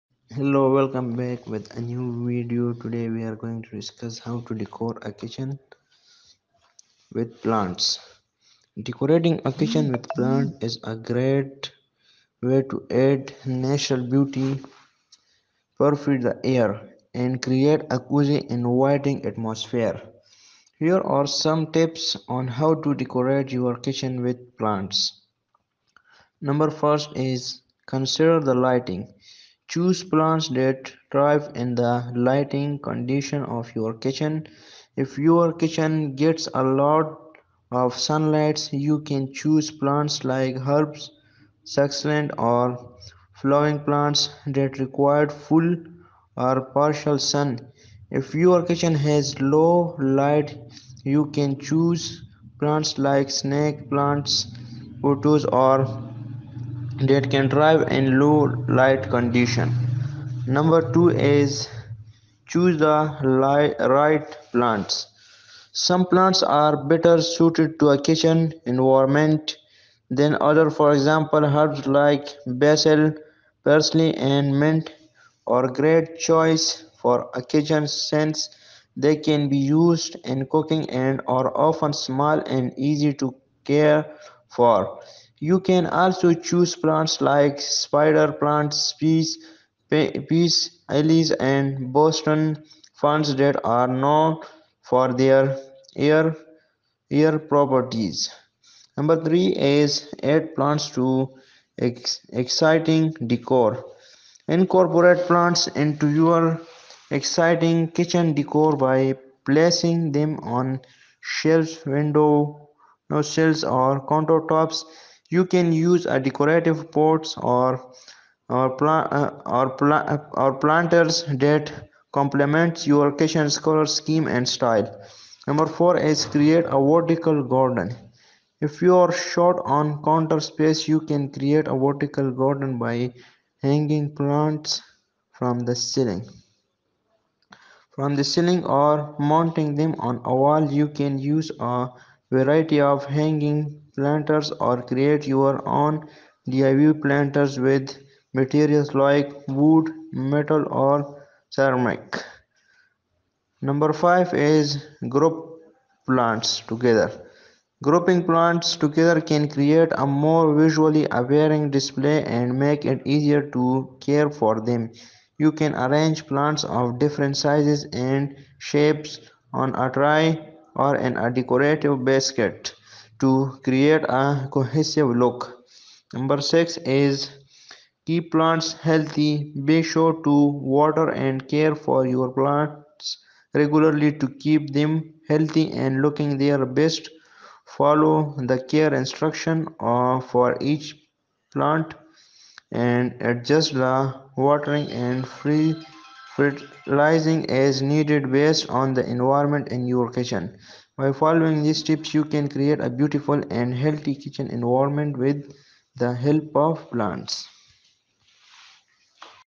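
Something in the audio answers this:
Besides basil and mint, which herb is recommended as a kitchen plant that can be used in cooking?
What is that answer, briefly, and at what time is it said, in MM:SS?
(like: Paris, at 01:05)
Parsley, at 01:13.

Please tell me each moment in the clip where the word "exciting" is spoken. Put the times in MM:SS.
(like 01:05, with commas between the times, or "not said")
01:42, 01:47.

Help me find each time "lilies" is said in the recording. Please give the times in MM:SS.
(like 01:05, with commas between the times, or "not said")
01:30.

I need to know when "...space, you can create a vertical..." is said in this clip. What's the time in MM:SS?
02:10.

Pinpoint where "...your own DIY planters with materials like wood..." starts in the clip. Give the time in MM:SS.
02:25.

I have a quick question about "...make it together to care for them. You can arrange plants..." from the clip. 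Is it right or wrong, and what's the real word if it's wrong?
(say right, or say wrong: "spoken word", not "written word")
wrong: "easier", not "together".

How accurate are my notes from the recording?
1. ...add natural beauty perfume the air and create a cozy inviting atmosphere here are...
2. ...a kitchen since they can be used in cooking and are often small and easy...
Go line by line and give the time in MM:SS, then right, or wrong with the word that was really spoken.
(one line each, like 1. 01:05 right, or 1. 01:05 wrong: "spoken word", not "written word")
1. 00:12 right
2. 01:17 right.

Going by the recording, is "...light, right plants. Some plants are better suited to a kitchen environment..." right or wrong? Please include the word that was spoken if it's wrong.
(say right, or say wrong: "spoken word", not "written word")
right.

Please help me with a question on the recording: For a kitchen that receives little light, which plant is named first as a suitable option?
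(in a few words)
Snake plants.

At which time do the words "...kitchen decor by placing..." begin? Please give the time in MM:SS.
01:47.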